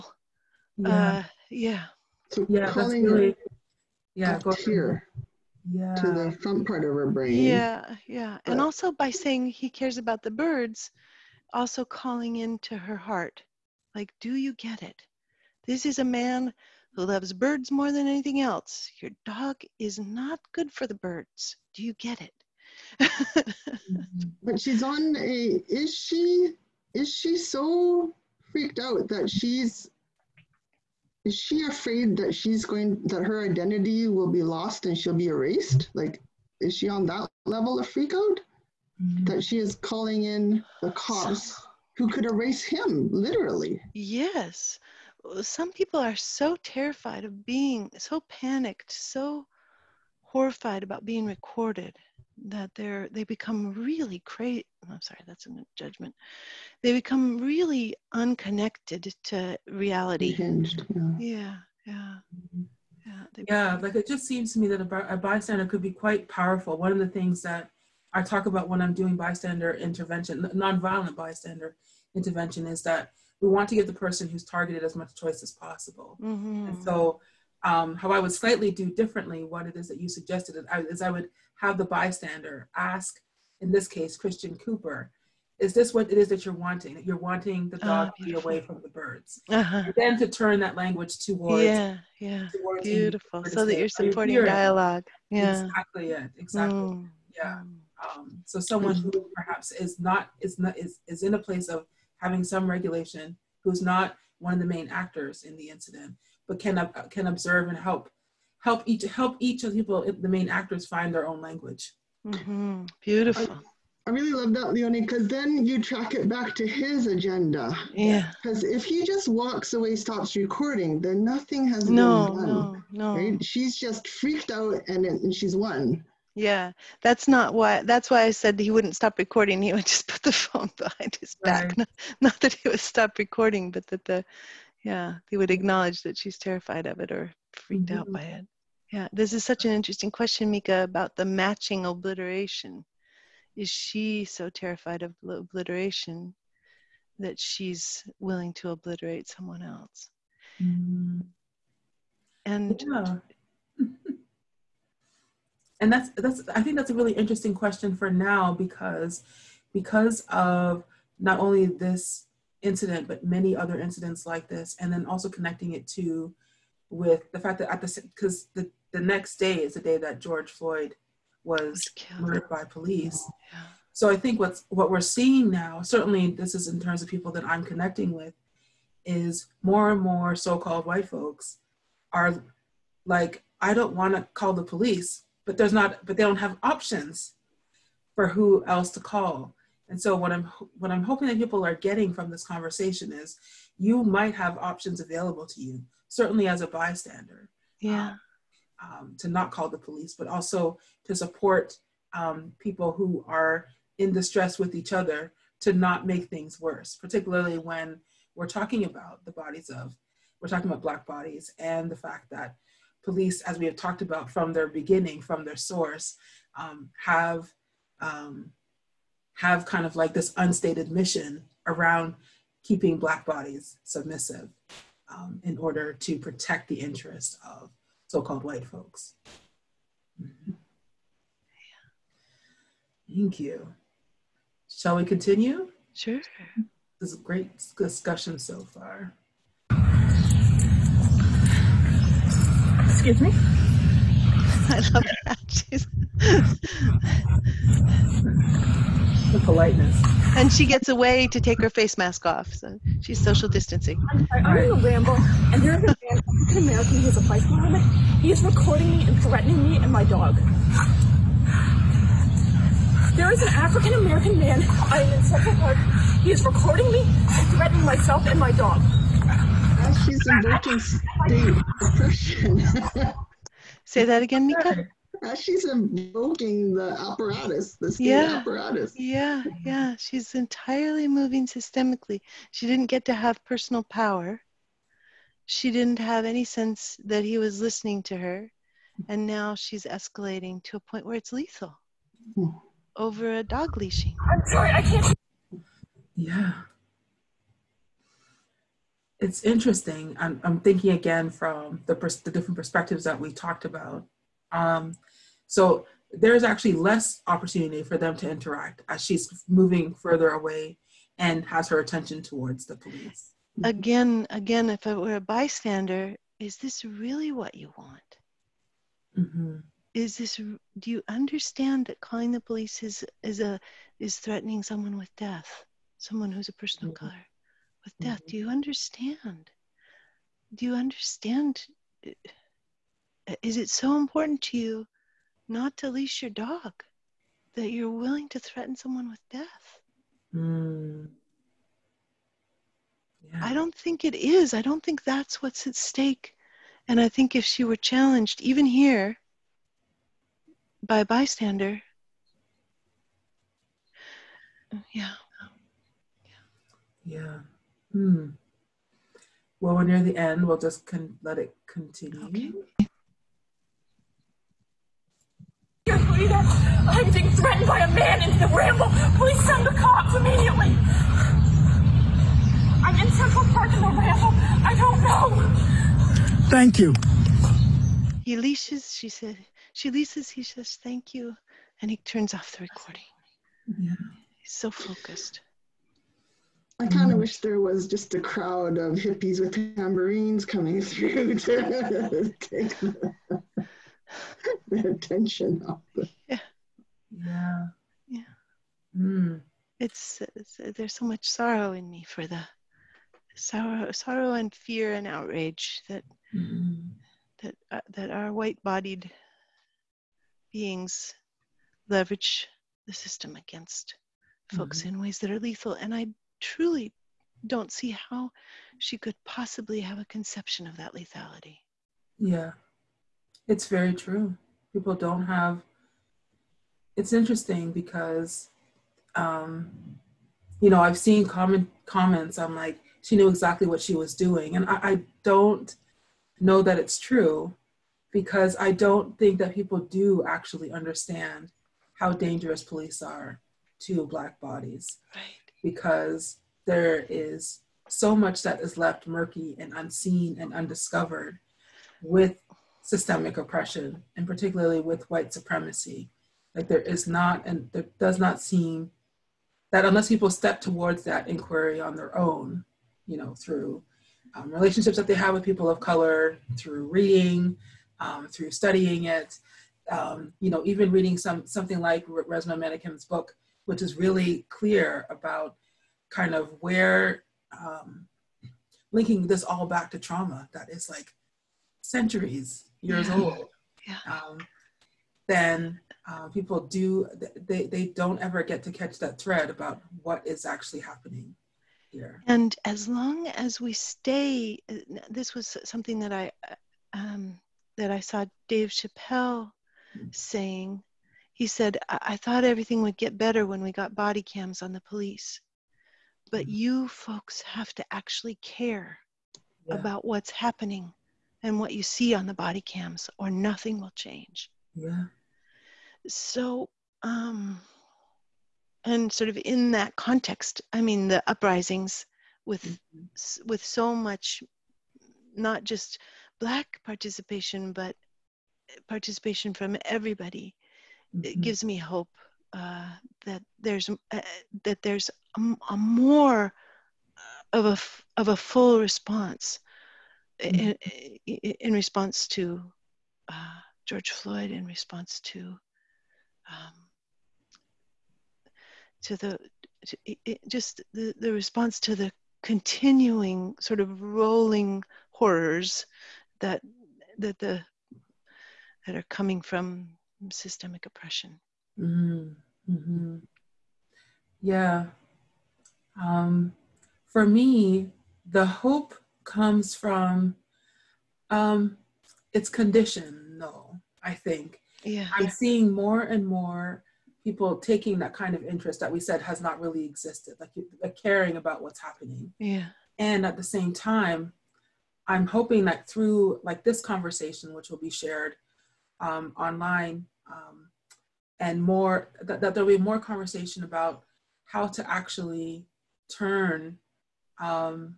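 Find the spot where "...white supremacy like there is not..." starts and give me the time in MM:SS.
07:35.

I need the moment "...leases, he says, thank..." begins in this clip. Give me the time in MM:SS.
06:19.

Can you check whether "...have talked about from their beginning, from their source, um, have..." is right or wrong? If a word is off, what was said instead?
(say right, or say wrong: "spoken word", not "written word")
right.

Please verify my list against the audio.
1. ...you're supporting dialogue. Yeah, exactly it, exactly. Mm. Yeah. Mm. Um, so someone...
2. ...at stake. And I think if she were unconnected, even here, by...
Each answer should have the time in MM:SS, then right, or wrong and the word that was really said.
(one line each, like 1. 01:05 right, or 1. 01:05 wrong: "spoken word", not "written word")
1. 01:33 right
2. 05:45 wrong: "challenged", not "unconnected".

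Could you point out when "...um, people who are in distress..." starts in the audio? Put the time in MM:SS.
03:22.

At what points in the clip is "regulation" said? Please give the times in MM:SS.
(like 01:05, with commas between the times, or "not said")
01:42.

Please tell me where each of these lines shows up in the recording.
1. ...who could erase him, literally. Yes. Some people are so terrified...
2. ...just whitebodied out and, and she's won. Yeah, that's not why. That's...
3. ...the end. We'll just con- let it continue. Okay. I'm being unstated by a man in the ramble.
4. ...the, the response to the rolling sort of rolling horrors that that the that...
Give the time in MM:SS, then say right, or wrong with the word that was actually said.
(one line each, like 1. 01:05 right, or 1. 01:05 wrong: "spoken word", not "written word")
1. 00:41 right
2. 02:03 wrong: "freaked", not "whitebodied"
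3. 06:00 wrong: "threatened", not "unstated"
4. 09:10 wrong: "continuing", not "rolling".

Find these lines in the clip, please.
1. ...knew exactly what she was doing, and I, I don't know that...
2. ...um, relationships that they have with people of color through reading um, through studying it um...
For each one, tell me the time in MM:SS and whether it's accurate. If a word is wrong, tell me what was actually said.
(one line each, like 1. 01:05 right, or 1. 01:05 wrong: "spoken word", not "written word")
1. 07:13 right
2. 07:44 right.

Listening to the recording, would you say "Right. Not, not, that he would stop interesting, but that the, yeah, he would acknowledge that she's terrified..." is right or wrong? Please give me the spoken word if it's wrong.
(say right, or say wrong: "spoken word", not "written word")
wrong: "recording", not "interesting".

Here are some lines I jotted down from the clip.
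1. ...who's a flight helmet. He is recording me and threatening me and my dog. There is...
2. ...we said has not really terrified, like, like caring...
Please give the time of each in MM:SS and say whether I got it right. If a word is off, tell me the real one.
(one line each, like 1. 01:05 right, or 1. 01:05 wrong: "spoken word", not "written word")
1. 04:17 right
2. 09:38 wrong: "existed", not "terrified".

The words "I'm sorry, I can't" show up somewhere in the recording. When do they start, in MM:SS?
04:54.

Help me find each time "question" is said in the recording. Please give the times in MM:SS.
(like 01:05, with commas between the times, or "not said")
02:20, 02:37.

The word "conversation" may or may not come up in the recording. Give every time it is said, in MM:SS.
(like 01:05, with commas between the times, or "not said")
03:12, 09:46, 09:52.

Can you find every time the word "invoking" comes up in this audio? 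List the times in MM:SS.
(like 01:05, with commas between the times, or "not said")
04:30, 04:35.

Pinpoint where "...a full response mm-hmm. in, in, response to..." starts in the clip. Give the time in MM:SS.
08:58.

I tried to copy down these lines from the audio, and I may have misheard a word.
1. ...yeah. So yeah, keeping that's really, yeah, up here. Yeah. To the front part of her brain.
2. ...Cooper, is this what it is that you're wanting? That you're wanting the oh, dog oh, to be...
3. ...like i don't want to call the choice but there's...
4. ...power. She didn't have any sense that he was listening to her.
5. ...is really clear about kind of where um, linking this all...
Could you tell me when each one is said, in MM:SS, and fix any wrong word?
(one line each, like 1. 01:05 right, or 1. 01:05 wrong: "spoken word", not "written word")
1. 00:01 wrong: "calling", not "keeping"
2. 01:24 right
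3. 03:03 wrong: "police", not "choice"
4. 04:43 right
5. 07:53 right.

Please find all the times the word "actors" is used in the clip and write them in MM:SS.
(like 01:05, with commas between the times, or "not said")
01:44, 01:50.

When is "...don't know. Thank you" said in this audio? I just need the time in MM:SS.
06:14.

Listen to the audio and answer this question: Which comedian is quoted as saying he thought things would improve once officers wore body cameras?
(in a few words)
Dave Chappelle.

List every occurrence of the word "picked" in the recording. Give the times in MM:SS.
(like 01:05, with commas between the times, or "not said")
not said.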